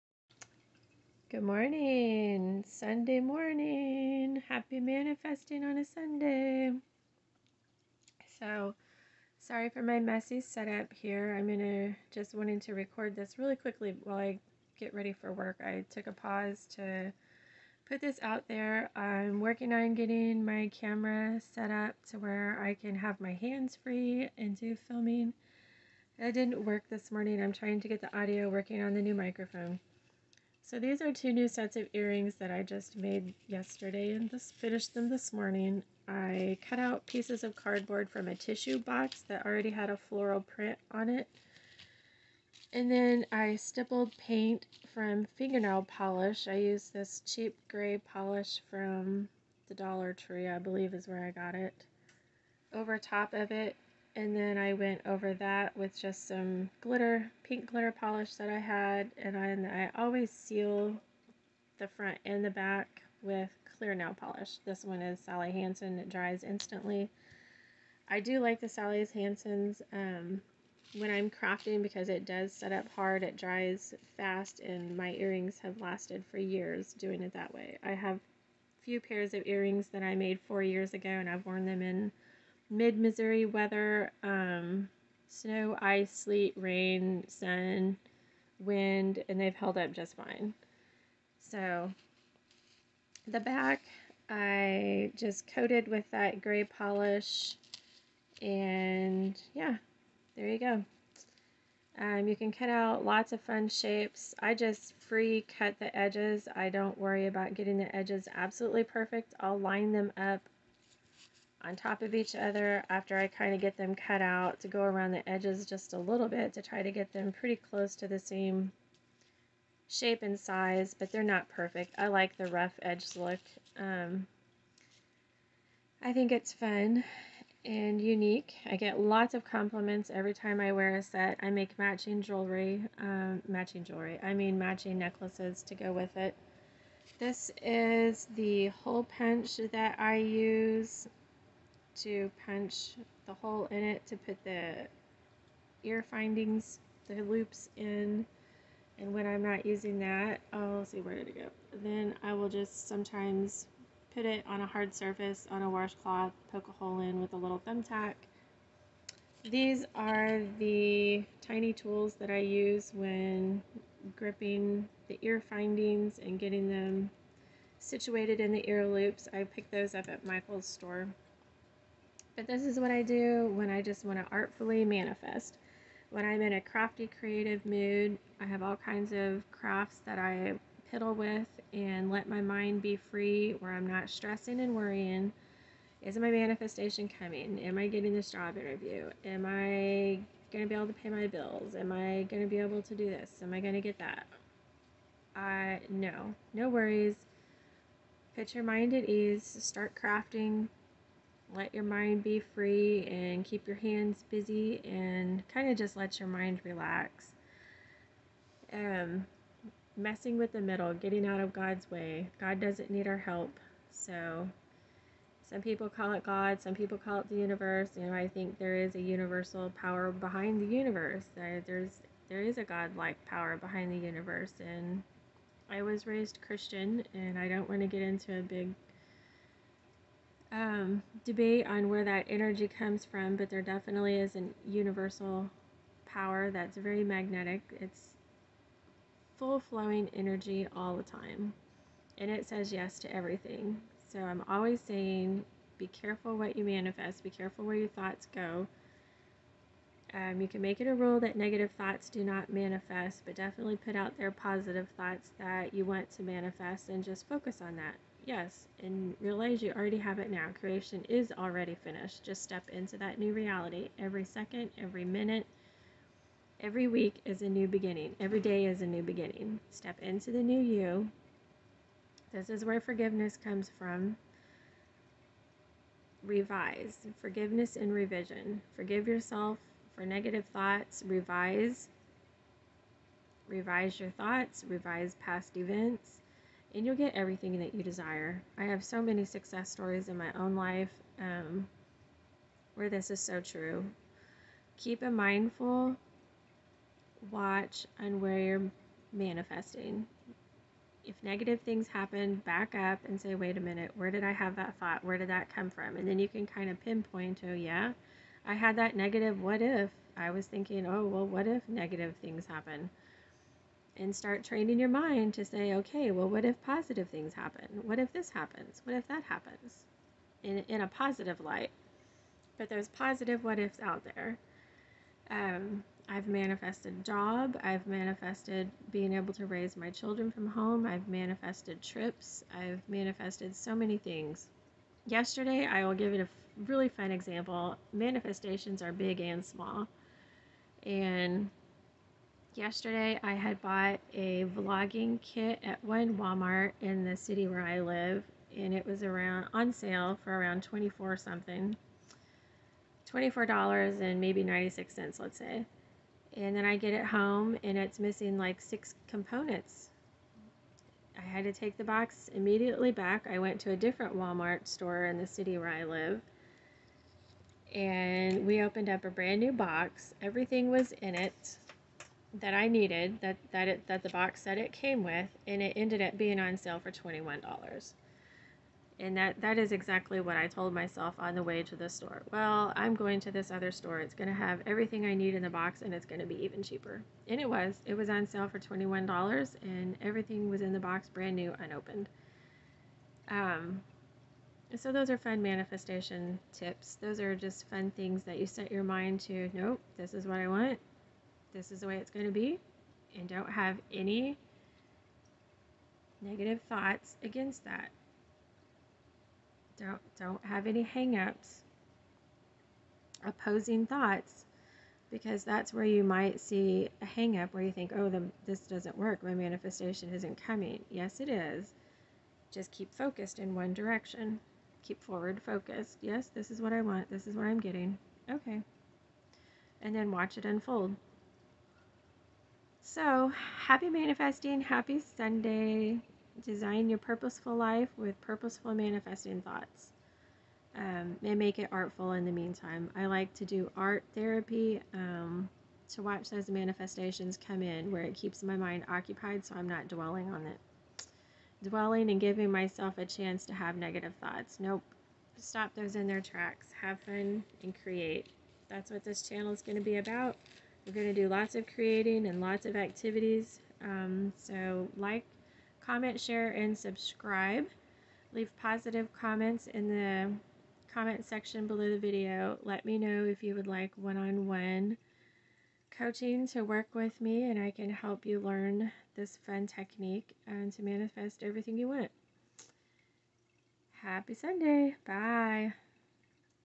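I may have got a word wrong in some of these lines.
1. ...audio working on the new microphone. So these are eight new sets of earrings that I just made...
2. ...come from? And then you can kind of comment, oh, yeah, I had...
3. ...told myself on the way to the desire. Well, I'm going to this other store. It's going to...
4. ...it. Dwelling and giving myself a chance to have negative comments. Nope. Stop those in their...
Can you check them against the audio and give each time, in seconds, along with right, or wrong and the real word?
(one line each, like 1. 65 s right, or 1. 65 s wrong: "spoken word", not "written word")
1. 28 s wrong: "two", not "eight"
2. 305 s wrong: "pinpoint", not "comment"
3. 380 s wrong: "store", not "desire"
4. 450 s wrong: "thoughts", not "comments".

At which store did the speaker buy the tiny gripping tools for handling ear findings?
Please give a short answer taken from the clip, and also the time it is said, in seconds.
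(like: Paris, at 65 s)
Michael's, at 170 s.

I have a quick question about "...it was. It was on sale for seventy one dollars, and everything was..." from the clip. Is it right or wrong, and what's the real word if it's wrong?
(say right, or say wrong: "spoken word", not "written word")
wrong: "twenty", not "seventy".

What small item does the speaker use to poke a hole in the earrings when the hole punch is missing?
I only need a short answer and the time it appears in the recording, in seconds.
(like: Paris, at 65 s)
Thumbtack, at 157 s.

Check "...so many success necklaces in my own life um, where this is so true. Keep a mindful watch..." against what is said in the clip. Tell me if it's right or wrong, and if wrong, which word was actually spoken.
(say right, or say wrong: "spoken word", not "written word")
wrong: "stories", not "necklaces".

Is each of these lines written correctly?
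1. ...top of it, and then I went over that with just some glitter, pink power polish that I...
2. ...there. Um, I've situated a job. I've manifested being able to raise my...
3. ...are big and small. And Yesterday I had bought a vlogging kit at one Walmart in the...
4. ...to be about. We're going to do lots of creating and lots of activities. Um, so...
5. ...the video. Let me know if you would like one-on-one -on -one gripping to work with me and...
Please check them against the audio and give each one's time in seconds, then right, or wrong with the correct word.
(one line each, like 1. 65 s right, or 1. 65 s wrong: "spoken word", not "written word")
1. 52 s wrong: "glitter", not "power"
2. 324 s wrong: "manifested", not "situated"
3. 338 s right
4. 459 s right
5. 471 s wrong: "coaching", not "gripping".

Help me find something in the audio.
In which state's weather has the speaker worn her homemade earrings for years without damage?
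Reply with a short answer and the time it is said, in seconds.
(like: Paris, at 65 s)
Missouri, at 82 s.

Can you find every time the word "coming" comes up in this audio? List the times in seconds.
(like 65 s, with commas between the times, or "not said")
187 s, 420 s.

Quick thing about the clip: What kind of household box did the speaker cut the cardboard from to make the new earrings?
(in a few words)
Tissue box.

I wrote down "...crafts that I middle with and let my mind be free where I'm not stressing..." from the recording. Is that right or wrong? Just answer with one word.
wrong.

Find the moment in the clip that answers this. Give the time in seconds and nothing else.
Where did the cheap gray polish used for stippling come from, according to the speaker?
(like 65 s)
49 s.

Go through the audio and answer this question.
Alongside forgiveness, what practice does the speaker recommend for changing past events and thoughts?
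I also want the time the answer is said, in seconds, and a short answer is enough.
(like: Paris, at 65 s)
Revision, at 277 s.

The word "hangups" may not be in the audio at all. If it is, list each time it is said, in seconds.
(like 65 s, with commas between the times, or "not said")
410 s, 417 s.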